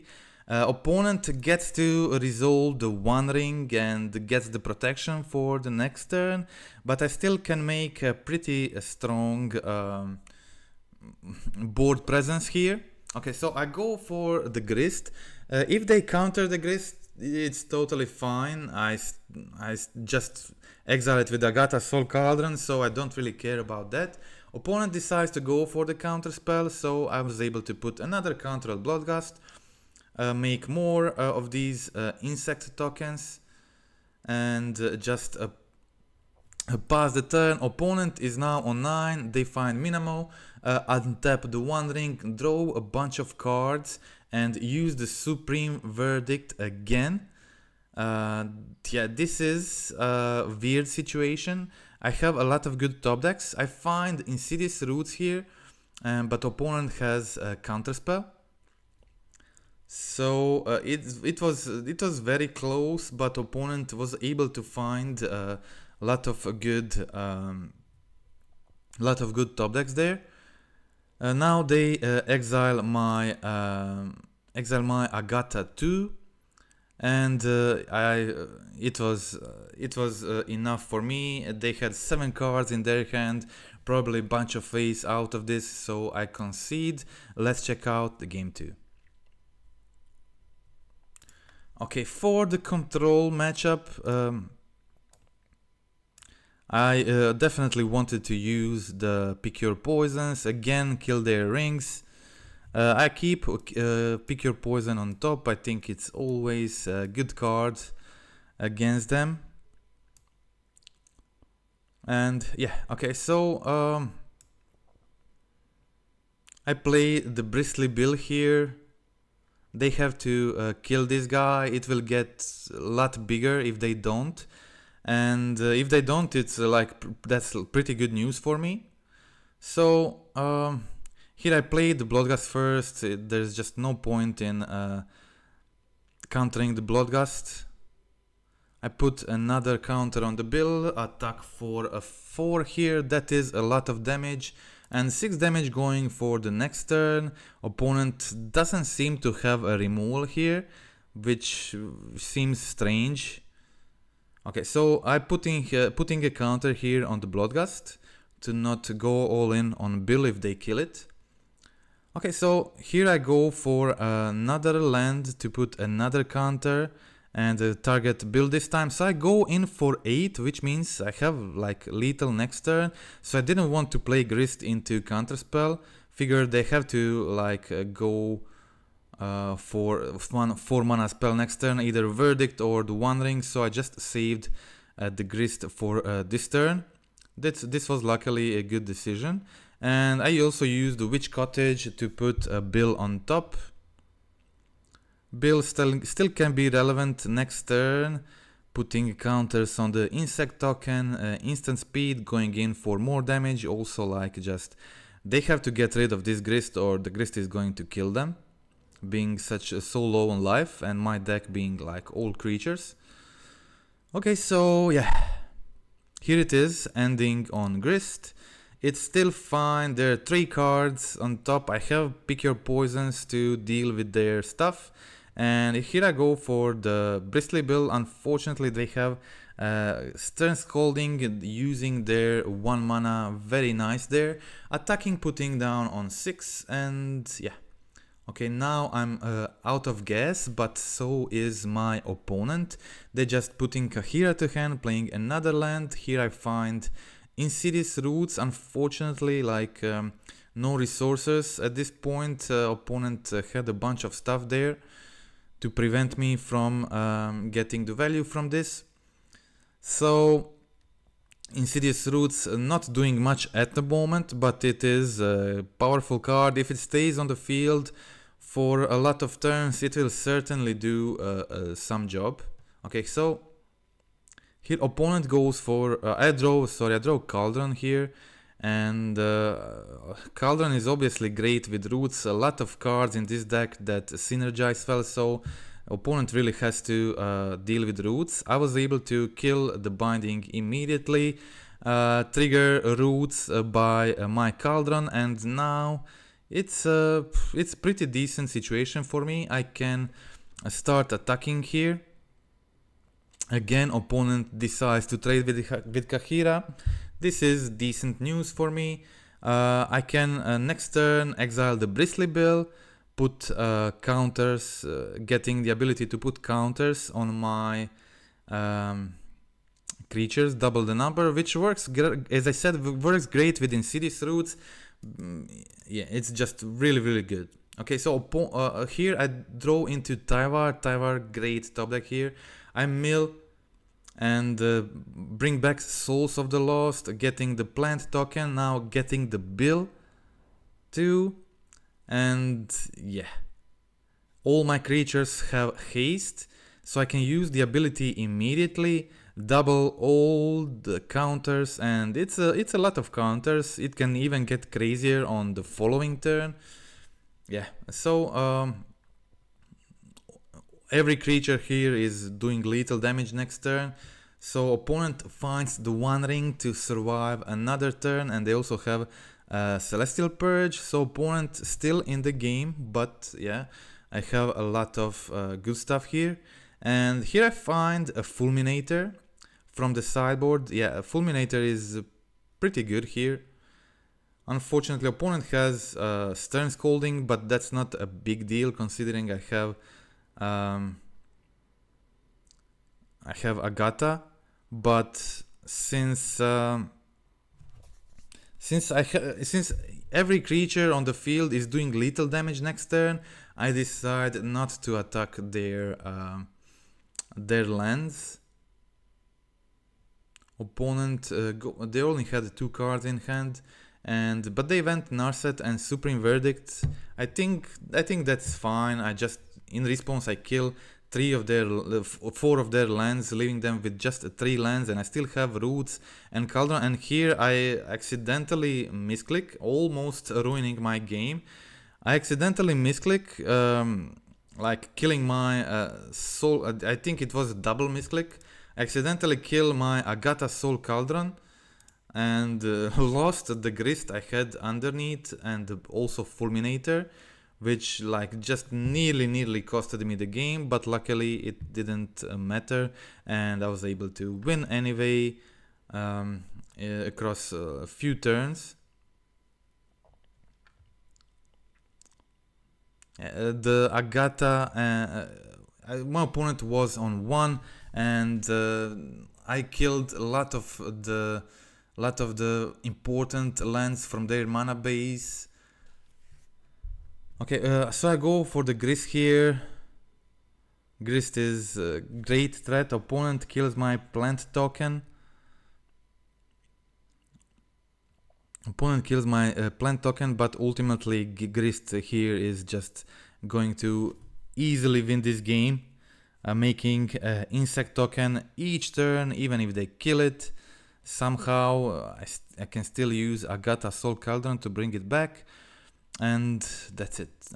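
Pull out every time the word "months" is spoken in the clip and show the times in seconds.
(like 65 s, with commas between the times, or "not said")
not said.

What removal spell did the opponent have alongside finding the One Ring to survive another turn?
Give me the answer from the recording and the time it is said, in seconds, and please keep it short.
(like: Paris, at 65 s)
Celestial Purge, at 369 s.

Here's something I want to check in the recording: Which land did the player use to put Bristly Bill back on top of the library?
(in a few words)
Witch's Cottage.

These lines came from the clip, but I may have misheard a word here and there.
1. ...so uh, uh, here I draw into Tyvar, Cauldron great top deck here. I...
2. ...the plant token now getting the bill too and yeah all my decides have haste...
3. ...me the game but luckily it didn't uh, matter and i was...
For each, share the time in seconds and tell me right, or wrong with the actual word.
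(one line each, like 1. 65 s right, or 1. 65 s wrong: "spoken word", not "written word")
1. 327 s wrong: "Tyvar", not "Cauldron"
2. 337 s wrong: "creatures", not "decides"
3. 450 s right.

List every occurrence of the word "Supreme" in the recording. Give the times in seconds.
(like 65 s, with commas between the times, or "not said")
45 s, 415 s.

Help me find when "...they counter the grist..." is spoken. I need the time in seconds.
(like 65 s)
15 s.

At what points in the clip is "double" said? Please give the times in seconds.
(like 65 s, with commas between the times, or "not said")
320 s, 349 s, 437 s.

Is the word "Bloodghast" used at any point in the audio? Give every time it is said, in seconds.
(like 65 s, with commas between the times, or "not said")
28 s, 132 s, 136 s, 157 s.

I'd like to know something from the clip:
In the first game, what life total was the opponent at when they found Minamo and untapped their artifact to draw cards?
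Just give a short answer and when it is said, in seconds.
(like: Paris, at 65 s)
9, at 38 s.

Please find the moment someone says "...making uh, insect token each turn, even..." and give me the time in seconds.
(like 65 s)
496 s.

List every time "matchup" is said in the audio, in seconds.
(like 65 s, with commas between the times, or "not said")
93 s.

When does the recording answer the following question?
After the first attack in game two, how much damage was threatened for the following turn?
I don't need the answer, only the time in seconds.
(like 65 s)
145 s.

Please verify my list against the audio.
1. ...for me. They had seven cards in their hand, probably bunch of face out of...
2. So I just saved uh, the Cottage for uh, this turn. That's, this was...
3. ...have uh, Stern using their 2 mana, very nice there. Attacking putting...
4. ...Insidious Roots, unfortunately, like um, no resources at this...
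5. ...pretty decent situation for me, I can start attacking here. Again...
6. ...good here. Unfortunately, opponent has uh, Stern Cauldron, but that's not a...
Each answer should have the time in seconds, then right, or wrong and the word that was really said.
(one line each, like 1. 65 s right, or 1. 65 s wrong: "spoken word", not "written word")
1. 80 s right
2. 183 s wrong: "Grist", not "Cottage"
3. 228 s wrong: "1", not "2"
4. 247 s right
5. 297 s right
6. 382 s wrong: "Scolding", not "Cauldron".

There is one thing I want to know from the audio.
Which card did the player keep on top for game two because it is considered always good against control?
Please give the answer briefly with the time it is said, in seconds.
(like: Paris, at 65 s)
Pick Your Poison, at 104 s.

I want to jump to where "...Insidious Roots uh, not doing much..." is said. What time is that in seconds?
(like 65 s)
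261 s.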